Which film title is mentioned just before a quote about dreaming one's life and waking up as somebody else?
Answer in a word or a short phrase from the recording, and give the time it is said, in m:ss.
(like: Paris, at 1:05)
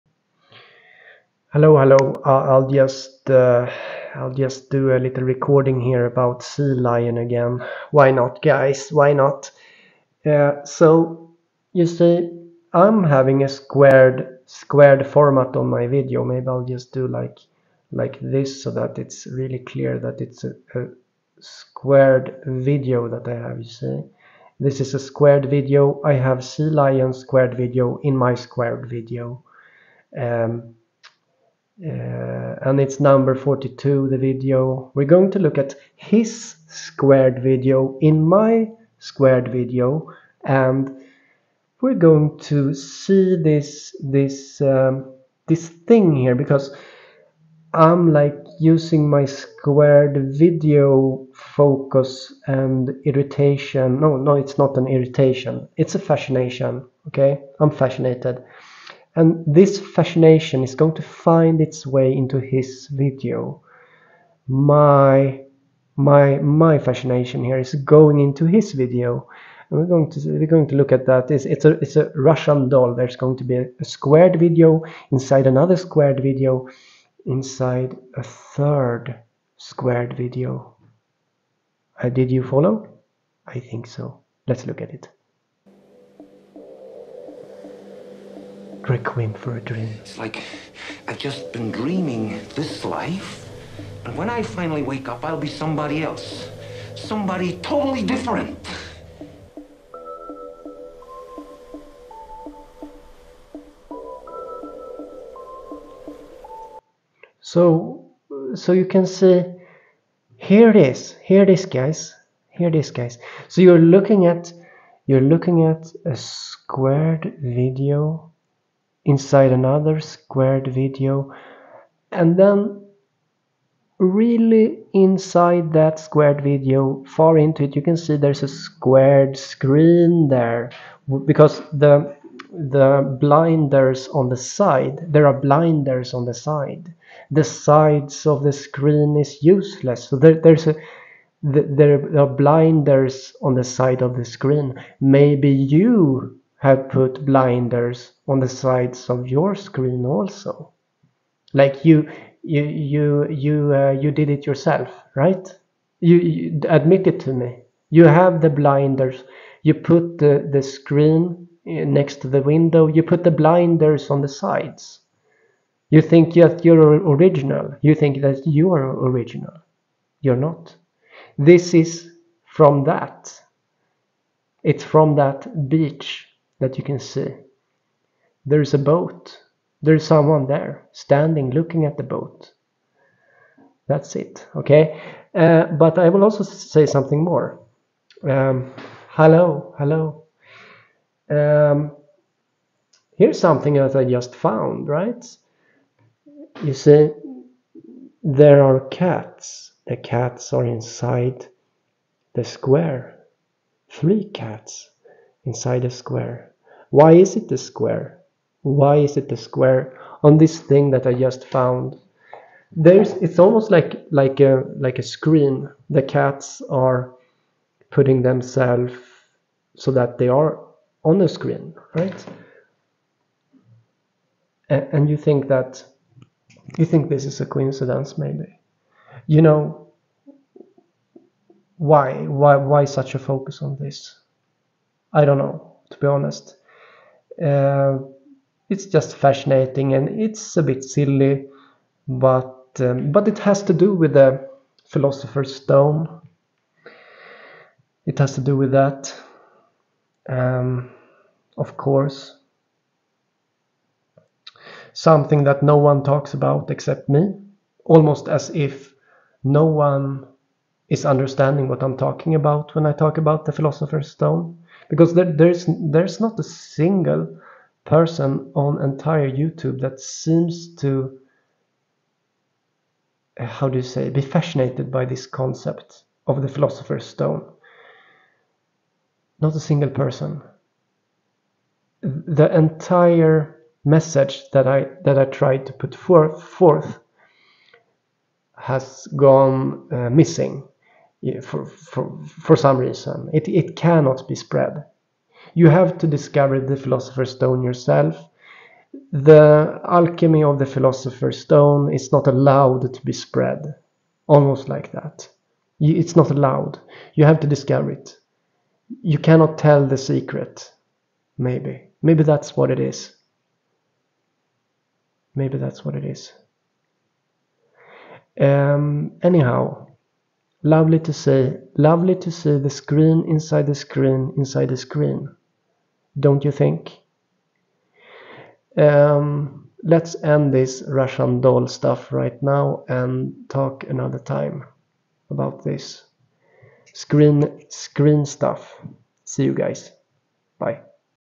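Requiem for a Dream, at 1:28.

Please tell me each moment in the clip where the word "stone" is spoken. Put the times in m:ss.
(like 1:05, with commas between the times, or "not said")
4:05, 4:24, 4:37, 4:57, 5:01.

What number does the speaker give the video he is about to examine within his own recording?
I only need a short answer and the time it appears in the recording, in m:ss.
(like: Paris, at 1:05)
42, at 0:32.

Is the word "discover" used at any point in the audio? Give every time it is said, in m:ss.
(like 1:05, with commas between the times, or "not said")
4:56, 5:07.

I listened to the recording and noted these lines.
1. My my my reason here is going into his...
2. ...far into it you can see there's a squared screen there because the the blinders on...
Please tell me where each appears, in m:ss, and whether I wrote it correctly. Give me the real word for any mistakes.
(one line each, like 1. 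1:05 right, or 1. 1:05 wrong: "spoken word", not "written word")
1. 1:04 wrong: "fascination", not "reason"
2. 2:07 right.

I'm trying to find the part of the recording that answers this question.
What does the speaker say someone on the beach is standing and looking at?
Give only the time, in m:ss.
3:01.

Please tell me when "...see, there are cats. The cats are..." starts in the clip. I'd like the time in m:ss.
3:16.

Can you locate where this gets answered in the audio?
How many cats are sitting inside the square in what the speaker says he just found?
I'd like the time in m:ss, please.
3:23.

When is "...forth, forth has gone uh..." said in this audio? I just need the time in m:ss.
4:45.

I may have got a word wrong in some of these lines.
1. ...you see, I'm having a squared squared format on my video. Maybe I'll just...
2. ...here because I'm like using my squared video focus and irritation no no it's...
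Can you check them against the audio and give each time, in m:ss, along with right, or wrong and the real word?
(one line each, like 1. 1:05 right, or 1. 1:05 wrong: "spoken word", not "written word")
1. 0:11 right
2. 0:46 right.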